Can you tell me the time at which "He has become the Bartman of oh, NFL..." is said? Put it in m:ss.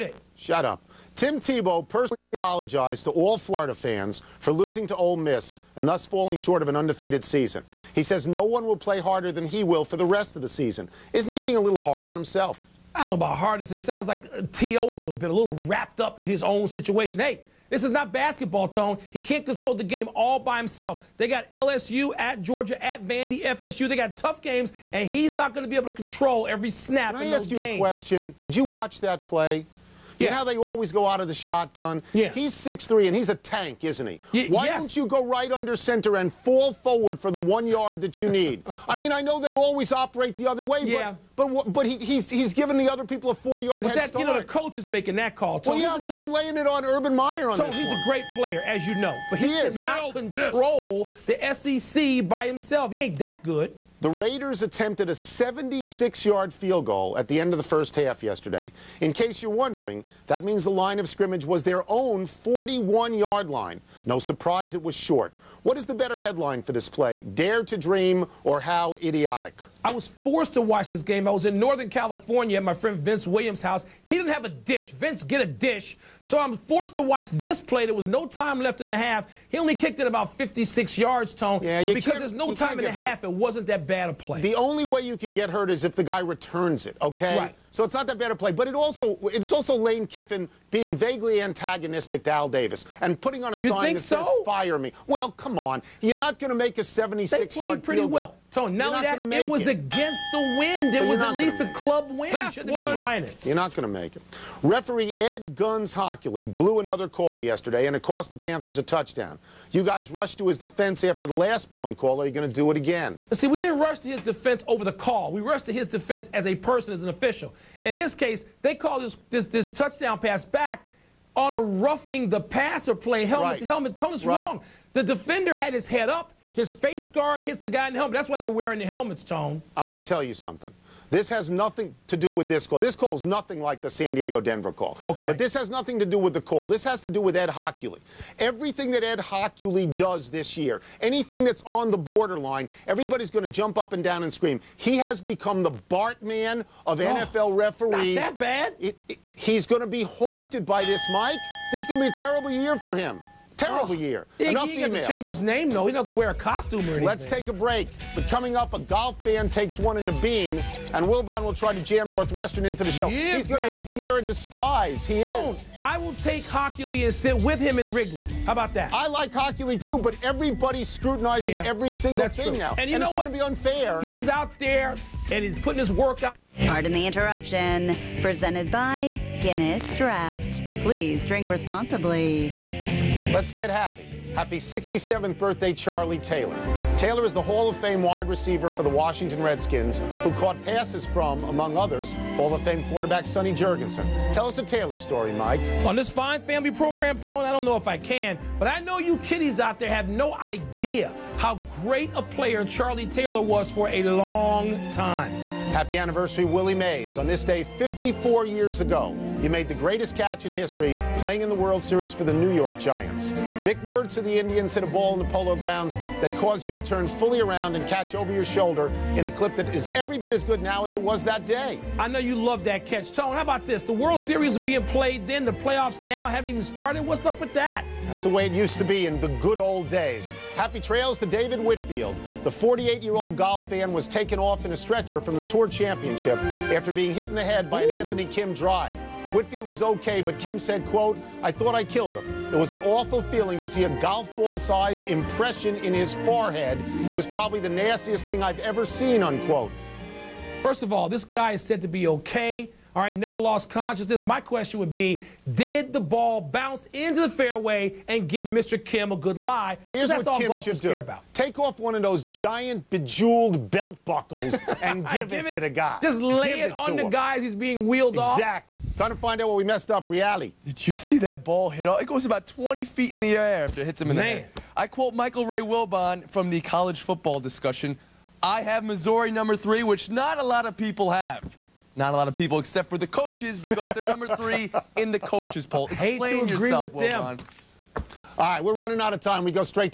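2:24.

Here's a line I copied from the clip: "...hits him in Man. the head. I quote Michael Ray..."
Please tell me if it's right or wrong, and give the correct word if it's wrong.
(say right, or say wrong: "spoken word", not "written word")
right.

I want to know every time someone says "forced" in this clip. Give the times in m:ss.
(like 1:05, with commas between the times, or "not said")
1:10, 1:16.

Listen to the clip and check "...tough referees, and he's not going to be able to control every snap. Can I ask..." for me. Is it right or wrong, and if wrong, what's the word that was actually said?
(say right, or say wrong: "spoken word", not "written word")
wrong: "games", not "referees".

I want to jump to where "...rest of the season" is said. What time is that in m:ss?
0:10.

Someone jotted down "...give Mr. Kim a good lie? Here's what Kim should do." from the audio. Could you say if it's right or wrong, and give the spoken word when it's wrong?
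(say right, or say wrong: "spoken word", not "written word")
right.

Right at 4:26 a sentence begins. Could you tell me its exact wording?
Just lay give it, it on the guy as he's being wheeled exactly.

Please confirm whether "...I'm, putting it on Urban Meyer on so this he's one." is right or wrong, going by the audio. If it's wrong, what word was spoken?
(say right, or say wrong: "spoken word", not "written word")
wrong: "laying", not "putting".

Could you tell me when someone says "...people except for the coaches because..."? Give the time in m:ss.
4:42.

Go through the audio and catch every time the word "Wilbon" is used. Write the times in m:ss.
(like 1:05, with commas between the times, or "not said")
2:41, 4:35, 4:47.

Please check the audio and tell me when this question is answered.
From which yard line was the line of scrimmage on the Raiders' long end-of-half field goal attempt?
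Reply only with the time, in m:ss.
1:01.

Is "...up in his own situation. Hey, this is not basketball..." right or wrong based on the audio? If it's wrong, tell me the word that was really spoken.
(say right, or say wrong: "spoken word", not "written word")
right.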